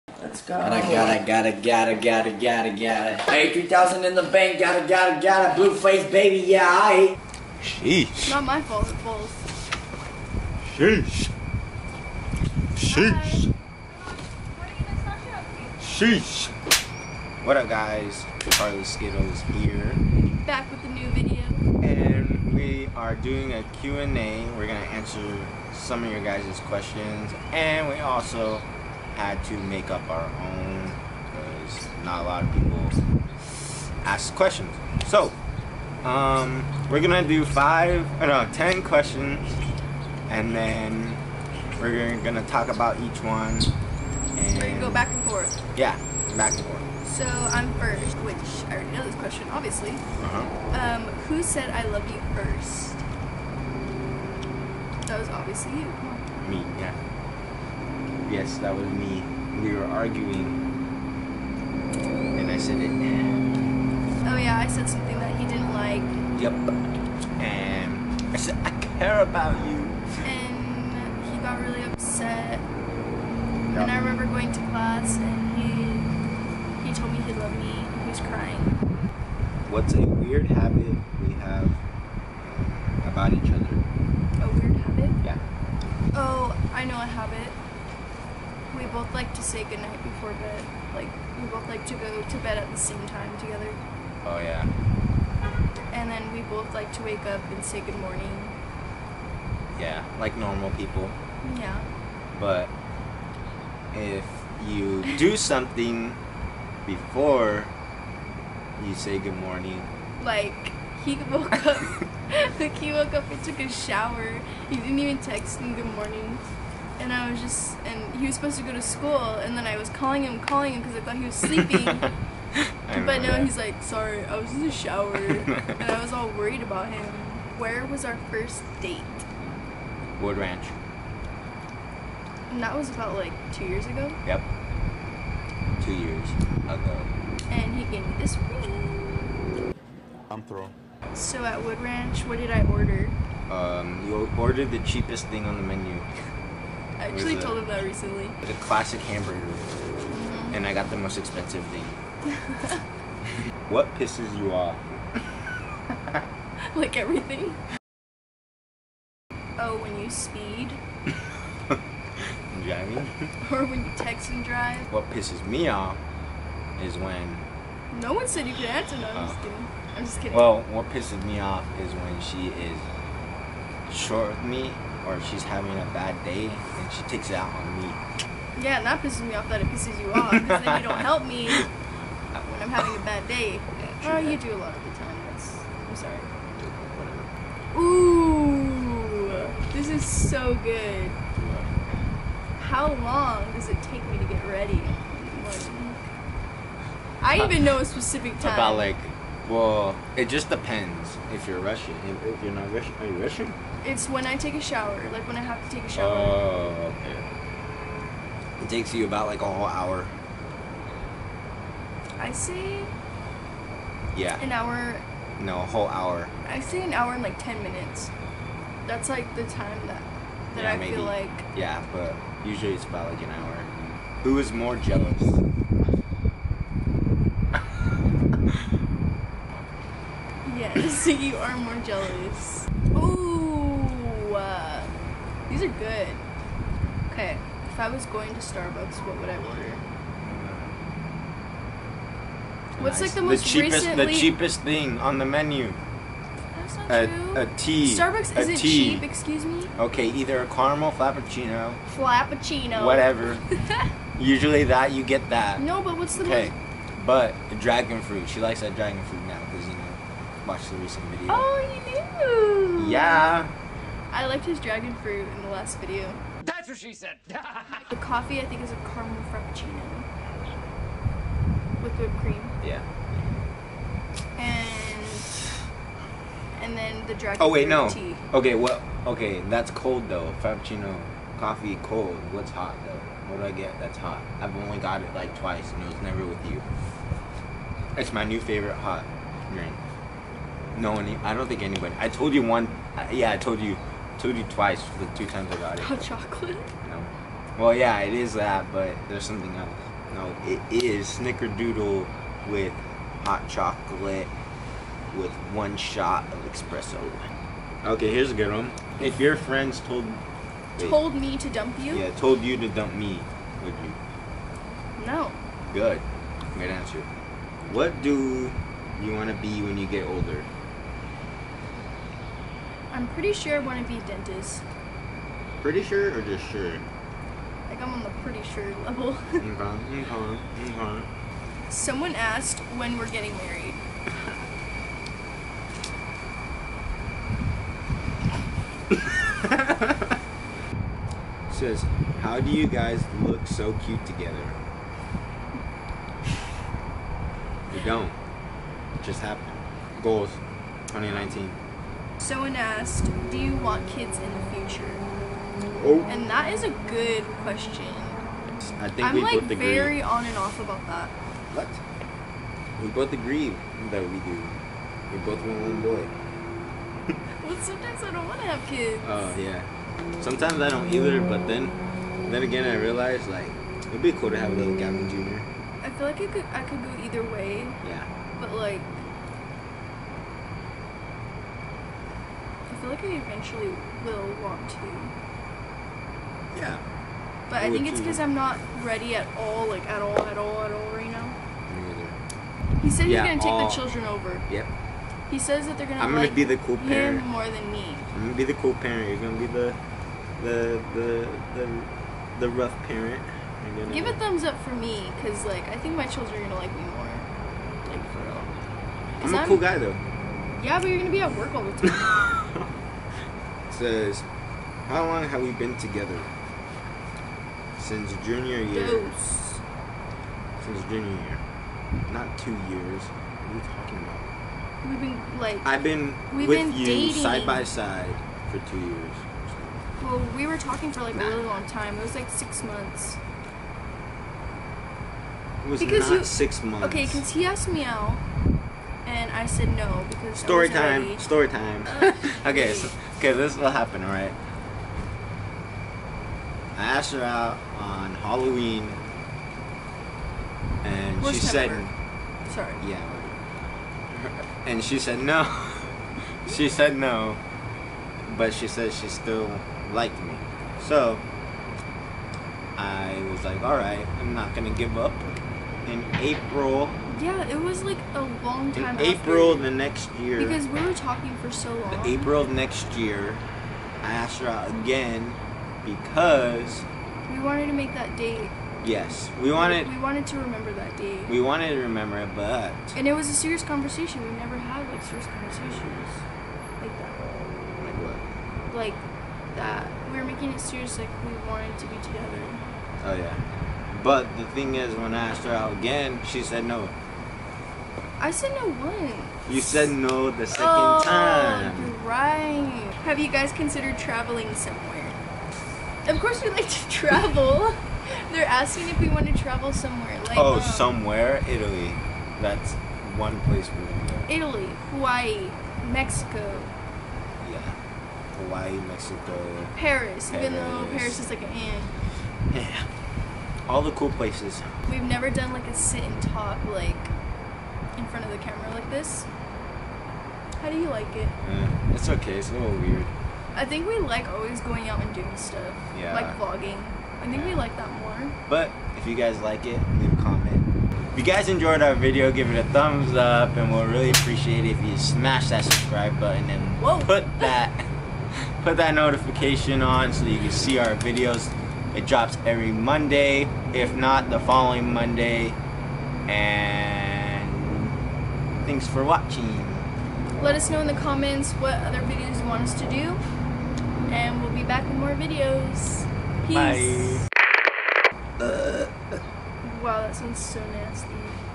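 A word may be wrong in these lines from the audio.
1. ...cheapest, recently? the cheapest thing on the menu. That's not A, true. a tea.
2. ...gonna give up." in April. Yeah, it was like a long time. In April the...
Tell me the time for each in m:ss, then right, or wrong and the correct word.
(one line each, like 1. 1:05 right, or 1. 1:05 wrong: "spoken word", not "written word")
1. 4:03 right
2. 7:44 right.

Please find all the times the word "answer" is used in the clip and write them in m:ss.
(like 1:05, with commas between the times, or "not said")
0:24, 2:48, 5:16.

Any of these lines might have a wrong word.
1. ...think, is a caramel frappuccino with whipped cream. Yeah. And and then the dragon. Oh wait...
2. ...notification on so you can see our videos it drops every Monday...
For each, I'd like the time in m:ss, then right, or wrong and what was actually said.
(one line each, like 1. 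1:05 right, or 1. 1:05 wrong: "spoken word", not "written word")
1. 4:28 right
2. 9:08 right.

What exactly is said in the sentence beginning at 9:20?
Let us know in the comments what other videos you want us to do.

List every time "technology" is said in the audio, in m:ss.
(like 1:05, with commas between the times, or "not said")
not said.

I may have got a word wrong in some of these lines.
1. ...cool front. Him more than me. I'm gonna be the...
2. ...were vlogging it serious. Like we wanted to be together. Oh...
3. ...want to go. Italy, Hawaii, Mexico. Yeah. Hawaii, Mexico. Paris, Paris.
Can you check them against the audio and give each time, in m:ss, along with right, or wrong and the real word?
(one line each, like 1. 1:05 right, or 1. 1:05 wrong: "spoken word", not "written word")
1. 6:36 wrong: "parent", not "front"
2. 8:10 wrong: "making", not "vlogging"
3. 8:33 right.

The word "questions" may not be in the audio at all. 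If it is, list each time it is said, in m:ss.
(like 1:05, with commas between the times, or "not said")
0:26, 0:34, 0:38, 0:49, 5:57.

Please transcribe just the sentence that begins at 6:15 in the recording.
I feel like it could I could go either way.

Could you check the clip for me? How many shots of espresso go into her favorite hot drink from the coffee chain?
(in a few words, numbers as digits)
1.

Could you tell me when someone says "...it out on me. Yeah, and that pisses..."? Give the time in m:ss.
2:57.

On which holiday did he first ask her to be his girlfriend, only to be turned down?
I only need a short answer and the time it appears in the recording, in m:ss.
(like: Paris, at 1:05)
Halloween, at 7:28.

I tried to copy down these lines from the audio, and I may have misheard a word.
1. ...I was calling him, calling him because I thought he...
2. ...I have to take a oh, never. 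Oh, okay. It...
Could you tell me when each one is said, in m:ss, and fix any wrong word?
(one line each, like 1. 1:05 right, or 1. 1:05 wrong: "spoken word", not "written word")
1. 1:59 right
2. 3:25 wrong: "shower", not "never".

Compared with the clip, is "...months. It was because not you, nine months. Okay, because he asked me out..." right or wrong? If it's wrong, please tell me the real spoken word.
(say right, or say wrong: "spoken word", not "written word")
wrong: "six", not "nine".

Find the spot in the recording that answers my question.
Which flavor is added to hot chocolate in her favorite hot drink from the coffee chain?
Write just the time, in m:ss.
5:01.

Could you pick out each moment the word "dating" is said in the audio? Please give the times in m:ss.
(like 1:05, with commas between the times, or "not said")
7:06.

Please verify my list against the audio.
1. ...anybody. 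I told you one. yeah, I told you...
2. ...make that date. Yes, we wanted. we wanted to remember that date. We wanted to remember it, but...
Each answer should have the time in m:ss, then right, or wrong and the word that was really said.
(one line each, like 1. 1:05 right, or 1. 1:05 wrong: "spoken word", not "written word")
1. 4:51 right
2. 7:57 right.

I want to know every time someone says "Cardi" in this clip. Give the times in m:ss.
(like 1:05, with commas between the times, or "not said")
not said.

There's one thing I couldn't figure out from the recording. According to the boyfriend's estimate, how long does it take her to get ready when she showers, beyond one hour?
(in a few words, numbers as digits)
10 minutes.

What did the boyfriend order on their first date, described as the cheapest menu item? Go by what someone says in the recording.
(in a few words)
Classic hamburger.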